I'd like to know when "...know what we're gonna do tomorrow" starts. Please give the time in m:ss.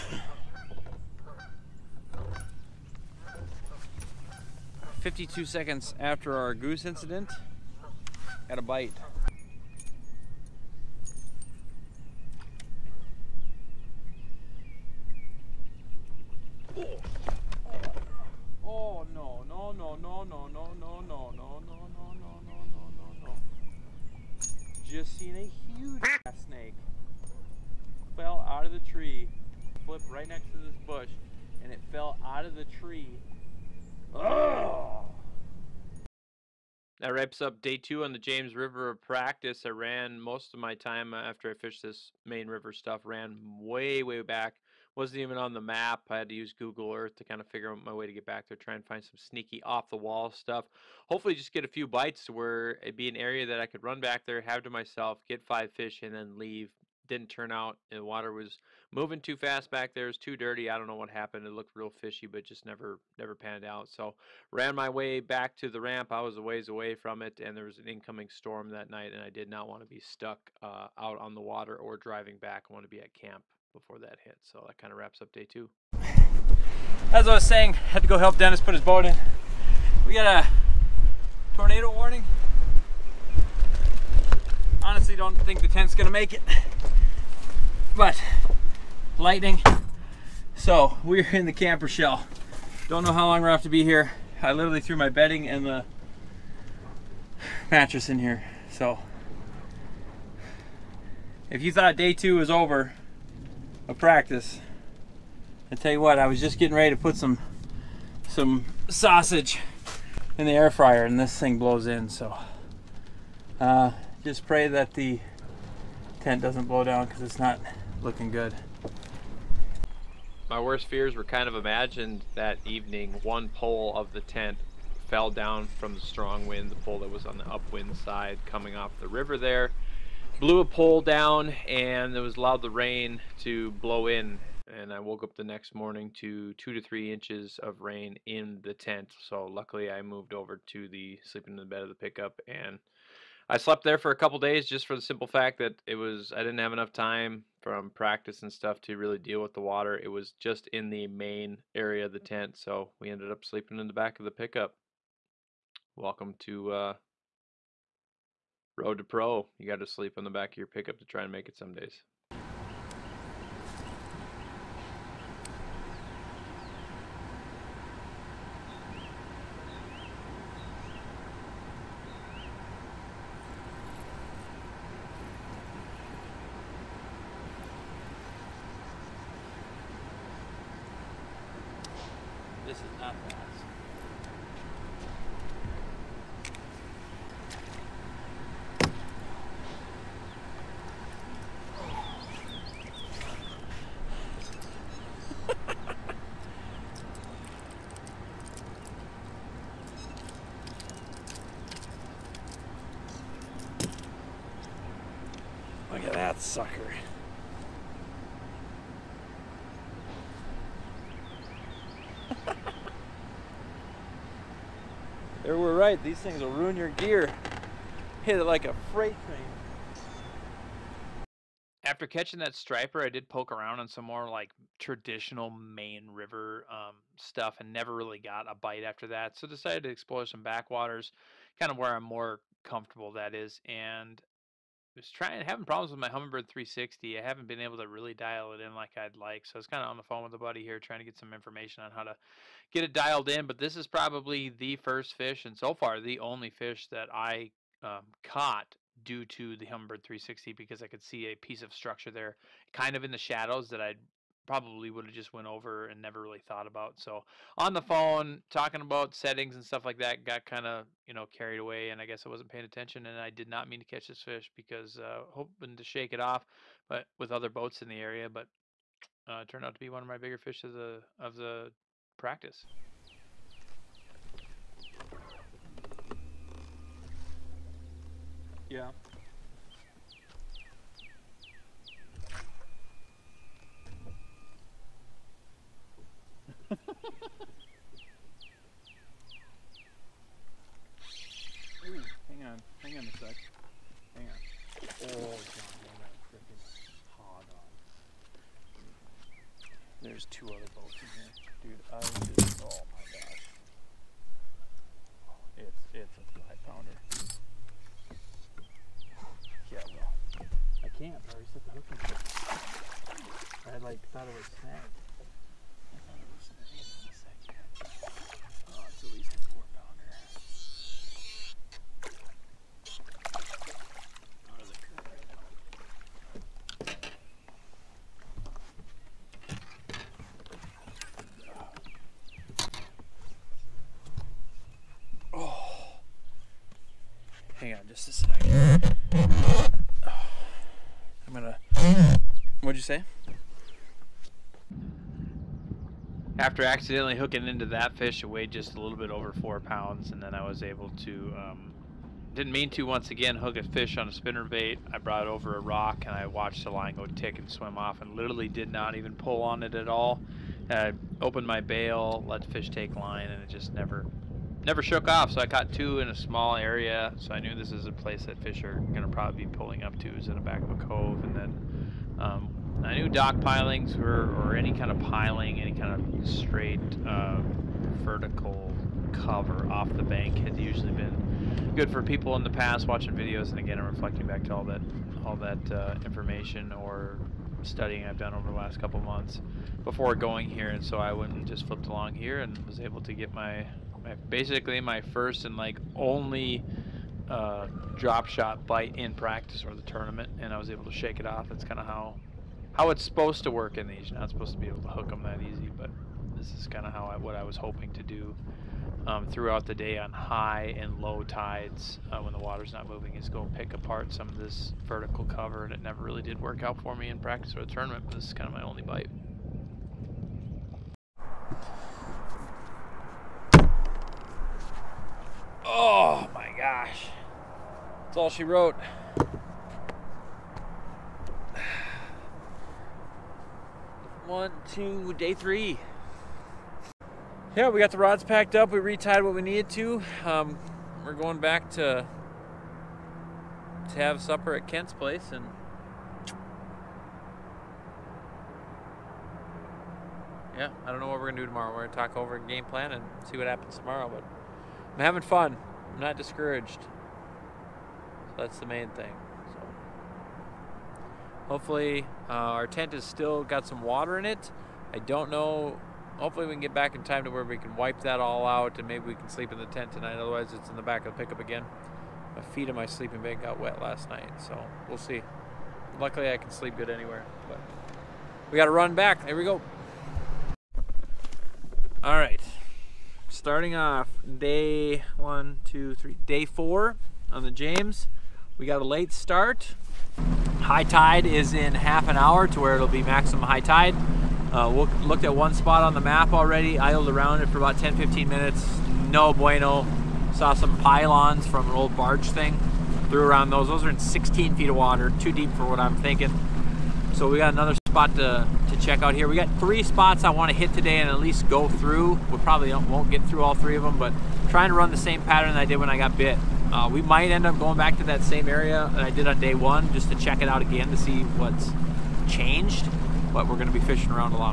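7:30.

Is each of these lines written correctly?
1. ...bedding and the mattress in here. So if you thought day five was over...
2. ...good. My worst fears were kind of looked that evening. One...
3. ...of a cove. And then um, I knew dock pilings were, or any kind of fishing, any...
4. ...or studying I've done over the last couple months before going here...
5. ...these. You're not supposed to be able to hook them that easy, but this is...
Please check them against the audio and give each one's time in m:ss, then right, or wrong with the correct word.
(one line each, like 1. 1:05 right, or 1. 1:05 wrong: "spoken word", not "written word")
1. 1:35 wrong: "two", not "five"
2. 1:58 wrong: "imagined", not "looked"
3. 6:10 wrong: "piling", not "fishing"
4. 6:26 right
5. 6:43 right.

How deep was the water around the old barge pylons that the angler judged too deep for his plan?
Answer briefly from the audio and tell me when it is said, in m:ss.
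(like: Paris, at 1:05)
16 feet, at 8:23.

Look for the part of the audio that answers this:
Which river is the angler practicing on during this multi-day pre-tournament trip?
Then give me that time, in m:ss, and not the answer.
0:38.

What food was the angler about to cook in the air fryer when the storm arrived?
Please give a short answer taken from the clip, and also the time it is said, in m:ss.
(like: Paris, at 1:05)
Sausage, at 1:48.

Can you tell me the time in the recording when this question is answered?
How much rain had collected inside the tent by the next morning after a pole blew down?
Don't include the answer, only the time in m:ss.
2:16.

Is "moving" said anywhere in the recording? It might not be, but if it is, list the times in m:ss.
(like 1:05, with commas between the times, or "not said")
0:58, 6:52.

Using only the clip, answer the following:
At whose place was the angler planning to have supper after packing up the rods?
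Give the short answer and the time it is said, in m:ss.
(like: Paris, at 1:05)
Kent's, at 7:24.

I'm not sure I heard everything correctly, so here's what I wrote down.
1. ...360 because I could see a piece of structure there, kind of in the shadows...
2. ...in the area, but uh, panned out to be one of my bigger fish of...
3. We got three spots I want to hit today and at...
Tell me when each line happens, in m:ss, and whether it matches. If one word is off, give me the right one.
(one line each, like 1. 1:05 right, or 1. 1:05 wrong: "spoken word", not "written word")
1. 4:10 right
2. 4:27 wrong: "turned", not "panned"
3. 8:29 right.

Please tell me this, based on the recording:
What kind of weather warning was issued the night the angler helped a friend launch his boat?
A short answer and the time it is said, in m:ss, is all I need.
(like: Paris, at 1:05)
Tornado warning, at 1:21.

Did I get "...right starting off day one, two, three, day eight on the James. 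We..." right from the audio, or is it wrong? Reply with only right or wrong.
wrong.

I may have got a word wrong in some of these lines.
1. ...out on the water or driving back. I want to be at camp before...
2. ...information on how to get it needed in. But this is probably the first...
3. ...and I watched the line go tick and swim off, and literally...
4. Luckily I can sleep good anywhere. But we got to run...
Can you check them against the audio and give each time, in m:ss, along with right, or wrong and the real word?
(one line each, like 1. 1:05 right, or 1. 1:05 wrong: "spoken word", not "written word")
1. 1:10 right
2. 4:01 wrong: "dialed", not "needed"
3. 5:56 right
4. 7:55 right.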